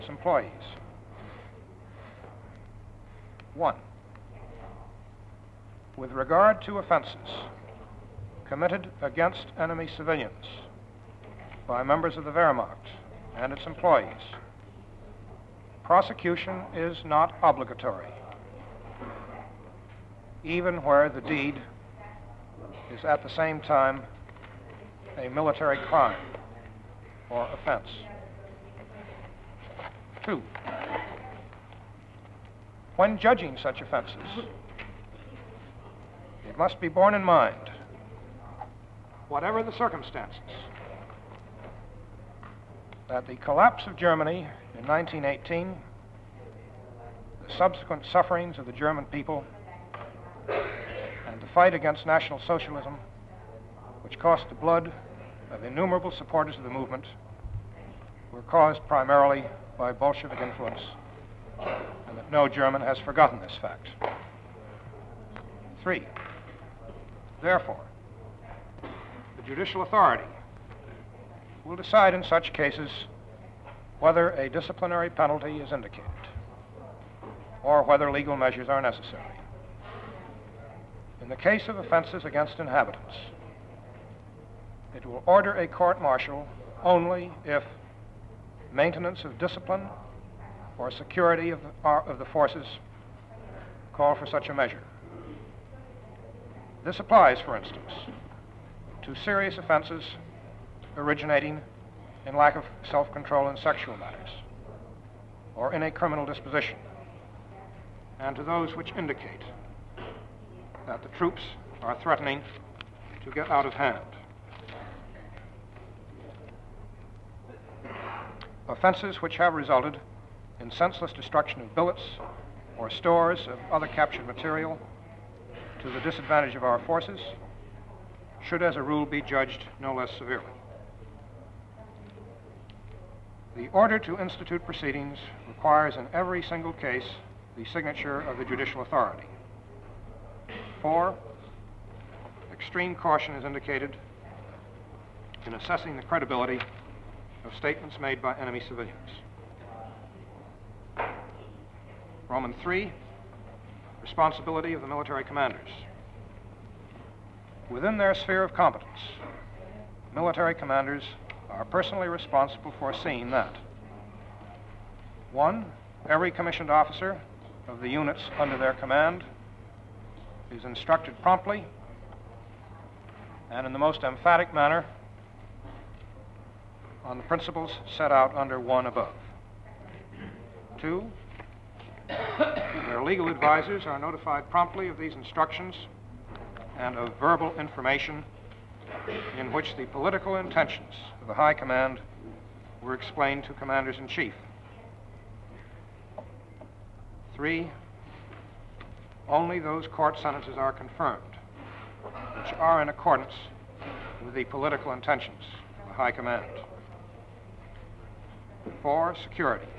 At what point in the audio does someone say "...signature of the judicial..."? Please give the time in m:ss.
2:17.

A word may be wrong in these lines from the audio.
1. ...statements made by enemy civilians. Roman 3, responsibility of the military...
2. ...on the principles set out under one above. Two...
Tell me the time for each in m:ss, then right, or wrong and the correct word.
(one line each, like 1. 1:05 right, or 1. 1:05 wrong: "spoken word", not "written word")
1. 2:27 right
2. 2:57 right.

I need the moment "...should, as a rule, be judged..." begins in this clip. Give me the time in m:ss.
2:08.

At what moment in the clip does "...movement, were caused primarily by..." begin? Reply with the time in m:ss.
0:56.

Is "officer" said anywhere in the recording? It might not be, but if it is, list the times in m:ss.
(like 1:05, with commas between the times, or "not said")
2:46.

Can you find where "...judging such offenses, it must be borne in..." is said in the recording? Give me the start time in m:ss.
0:33.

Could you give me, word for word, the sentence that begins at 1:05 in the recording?
Three, therefore, the judicial authority will decide in such cases whether a disciplinary penalty is indicated or whether legal measures are necessary.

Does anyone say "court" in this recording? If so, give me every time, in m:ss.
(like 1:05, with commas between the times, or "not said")
1:25, 3:19.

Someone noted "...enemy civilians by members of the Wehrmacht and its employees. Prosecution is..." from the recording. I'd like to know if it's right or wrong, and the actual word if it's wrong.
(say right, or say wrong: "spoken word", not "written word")
right.